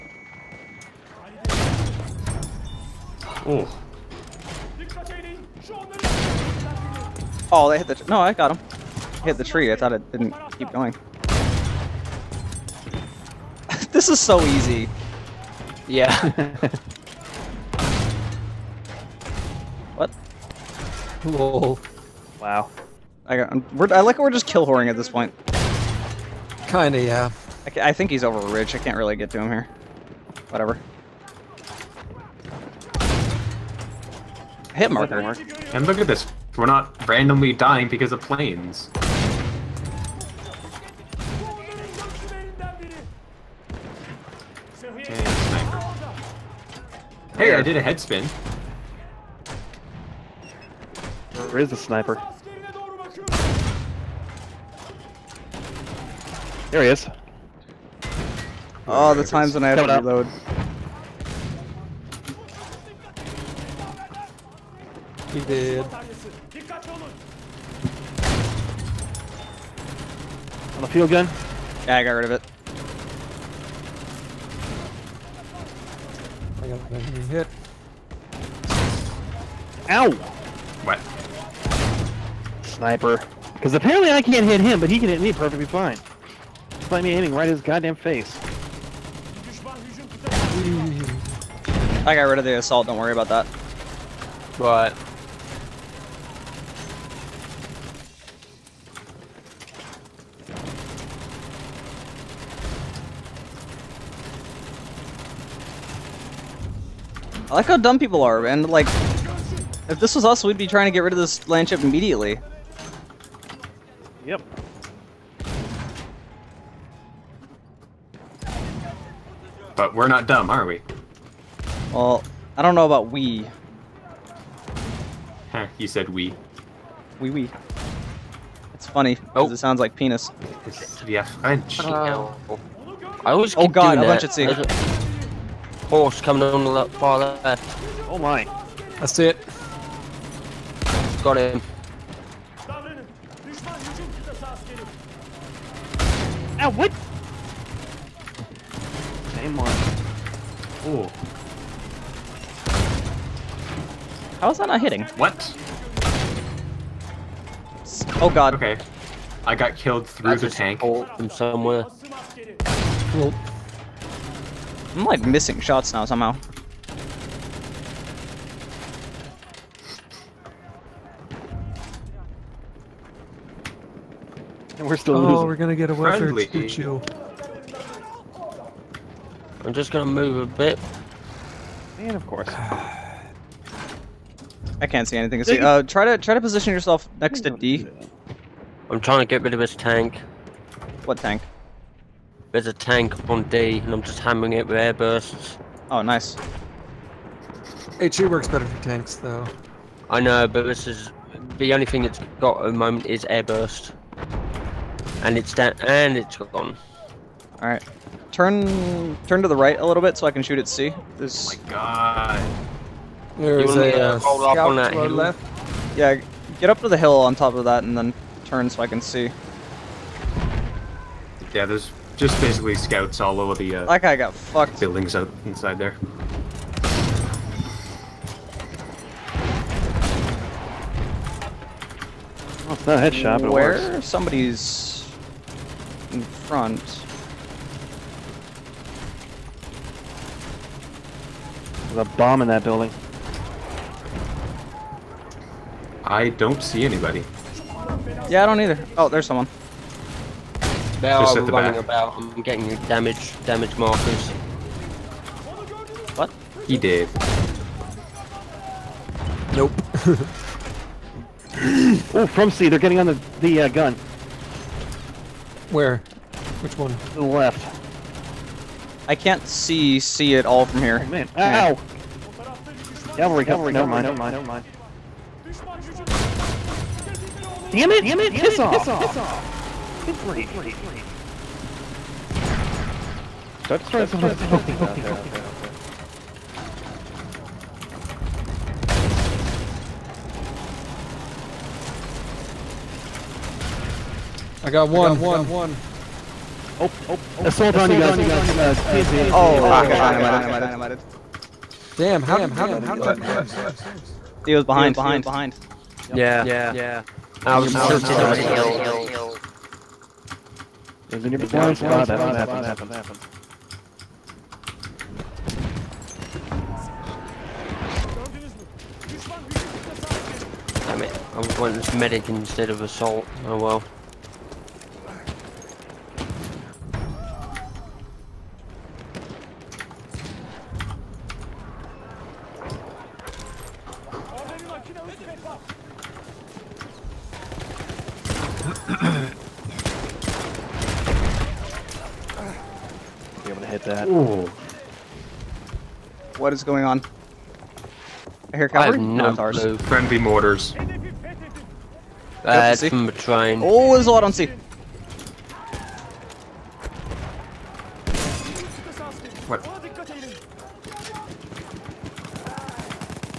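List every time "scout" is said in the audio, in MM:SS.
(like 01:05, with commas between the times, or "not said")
03:34, 03:42.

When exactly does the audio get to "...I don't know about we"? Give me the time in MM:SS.
02:02.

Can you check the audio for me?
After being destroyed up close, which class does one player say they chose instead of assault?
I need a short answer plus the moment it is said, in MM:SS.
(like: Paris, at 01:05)
Medic, at 05:21.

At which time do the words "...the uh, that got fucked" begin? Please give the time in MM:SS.
03:43.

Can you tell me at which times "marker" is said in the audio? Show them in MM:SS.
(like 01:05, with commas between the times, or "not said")
00:34, 04:13.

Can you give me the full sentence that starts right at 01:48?
Like, if this was us, we'd be trying to get rid of this land immediately.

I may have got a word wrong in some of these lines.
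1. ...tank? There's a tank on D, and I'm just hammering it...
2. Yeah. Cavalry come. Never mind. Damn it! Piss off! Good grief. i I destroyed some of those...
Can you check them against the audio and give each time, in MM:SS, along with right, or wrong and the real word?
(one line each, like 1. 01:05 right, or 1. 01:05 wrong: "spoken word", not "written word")
1. 03:11 right
2. 04:31 right.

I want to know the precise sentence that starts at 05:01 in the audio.
Damn, how did we let him get what?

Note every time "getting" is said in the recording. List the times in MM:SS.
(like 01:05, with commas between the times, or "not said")
04:12, 04:22.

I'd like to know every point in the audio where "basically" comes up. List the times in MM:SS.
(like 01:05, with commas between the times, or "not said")
03:42.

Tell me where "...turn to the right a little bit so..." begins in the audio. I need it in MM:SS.
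03:29.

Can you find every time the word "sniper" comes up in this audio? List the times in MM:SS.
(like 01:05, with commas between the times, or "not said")
00:51, 01:22.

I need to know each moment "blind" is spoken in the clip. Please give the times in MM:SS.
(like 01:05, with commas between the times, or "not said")
05:11.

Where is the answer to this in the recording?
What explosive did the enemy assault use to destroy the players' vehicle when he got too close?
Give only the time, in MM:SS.
04:58.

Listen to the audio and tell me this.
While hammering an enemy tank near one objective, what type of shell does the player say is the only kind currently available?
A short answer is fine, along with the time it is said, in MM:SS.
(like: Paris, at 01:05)
Airburst, at 03:23.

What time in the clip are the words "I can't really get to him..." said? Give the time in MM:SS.
00:28.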